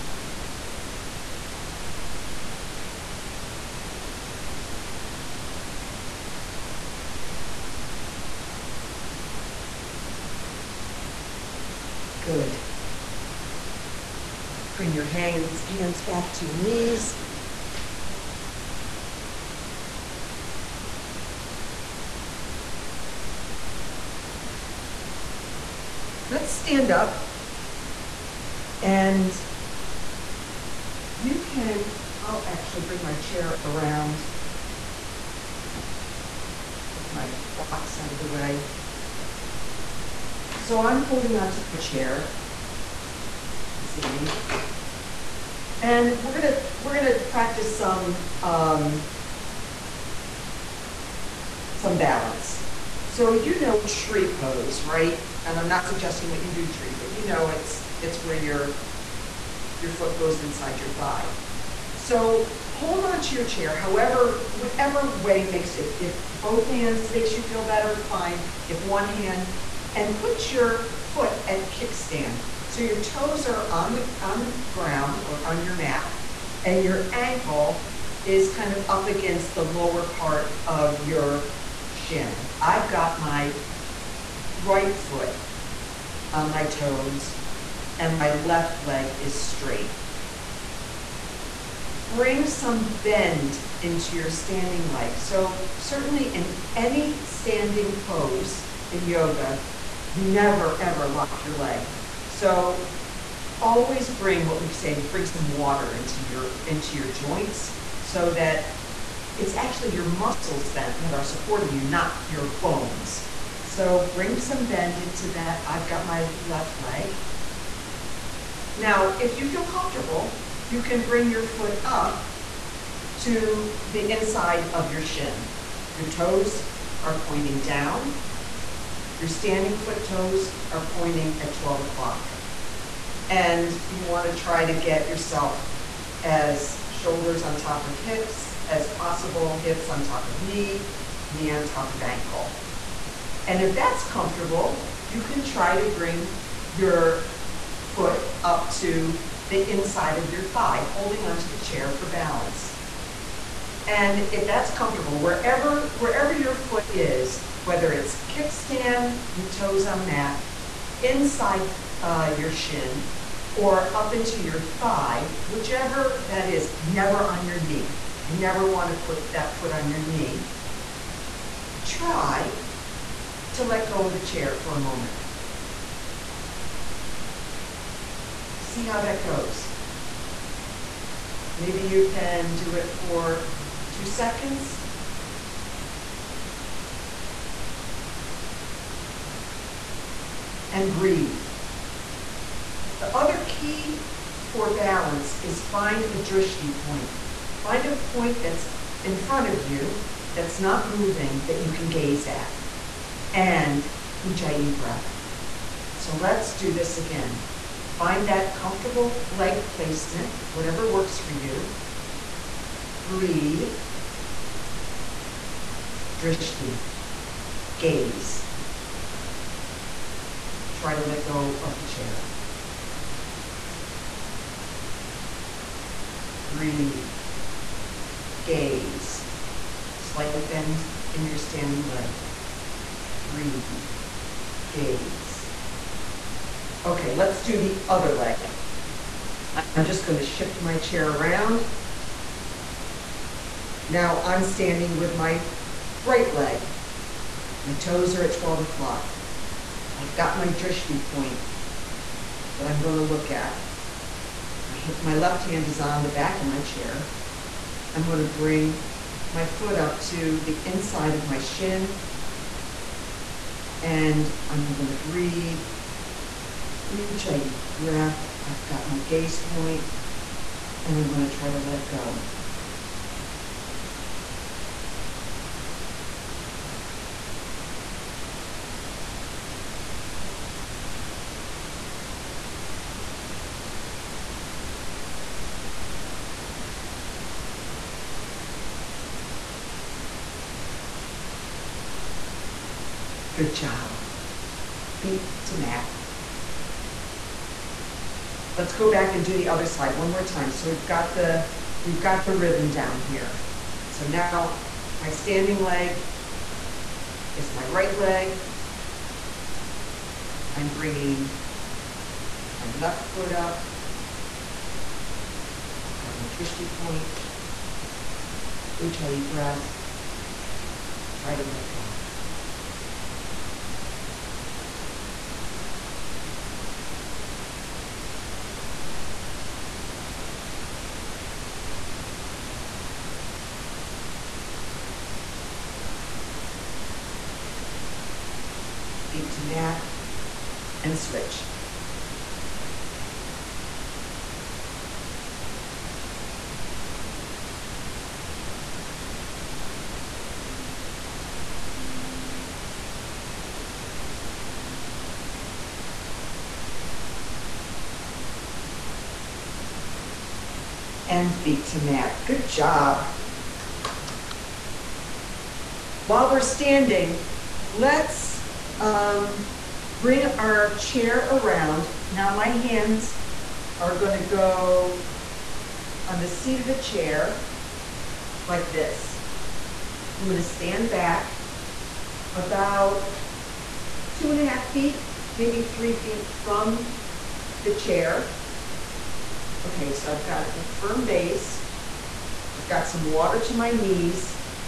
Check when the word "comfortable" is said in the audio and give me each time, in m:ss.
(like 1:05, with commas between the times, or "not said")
1:59, 2:24, 2:34, 3:28.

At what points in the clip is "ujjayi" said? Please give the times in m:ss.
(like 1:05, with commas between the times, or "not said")
3:24, 4:26, 5:18.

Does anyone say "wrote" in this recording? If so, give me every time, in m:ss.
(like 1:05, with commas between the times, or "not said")
not said.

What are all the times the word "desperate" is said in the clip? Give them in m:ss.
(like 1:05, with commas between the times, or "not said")
not said.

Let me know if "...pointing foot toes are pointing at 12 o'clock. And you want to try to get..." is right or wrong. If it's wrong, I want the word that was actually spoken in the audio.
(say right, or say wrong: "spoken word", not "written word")
wrong: "standing", not "pointing".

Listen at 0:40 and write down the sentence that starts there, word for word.
So I'm holding onto my chair.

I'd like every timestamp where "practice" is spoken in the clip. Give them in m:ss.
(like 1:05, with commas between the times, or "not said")
0:47.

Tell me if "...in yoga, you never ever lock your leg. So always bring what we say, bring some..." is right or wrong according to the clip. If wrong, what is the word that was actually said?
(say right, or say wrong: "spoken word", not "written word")
right.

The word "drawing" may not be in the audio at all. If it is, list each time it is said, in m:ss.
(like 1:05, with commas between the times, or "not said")
not said.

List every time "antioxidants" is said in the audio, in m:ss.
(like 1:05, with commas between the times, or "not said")
not said.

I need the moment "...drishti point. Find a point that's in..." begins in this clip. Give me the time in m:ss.
3:16.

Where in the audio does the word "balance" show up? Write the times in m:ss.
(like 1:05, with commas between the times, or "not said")
0:51, 2:32, 3:14.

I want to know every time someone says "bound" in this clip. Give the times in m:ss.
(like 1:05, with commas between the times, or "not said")
not said.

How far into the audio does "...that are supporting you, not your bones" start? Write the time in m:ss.
1:51.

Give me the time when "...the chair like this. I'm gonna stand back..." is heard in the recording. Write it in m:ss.
6:16.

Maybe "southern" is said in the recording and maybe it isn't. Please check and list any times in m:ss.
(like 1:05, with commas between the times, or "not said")
not said.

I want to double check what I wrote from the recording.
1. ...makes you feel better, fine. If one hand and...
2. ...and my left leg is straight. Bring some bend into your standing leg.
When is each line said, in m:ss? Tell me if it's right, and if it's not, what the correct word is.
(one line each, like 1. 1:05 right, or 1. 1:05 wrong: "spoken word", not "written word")
1. 1:07 right
2. 1:27 right.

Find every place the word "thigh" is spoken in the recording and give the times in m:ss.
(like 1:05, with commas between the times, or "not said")
1:00, 2:30, 2:44.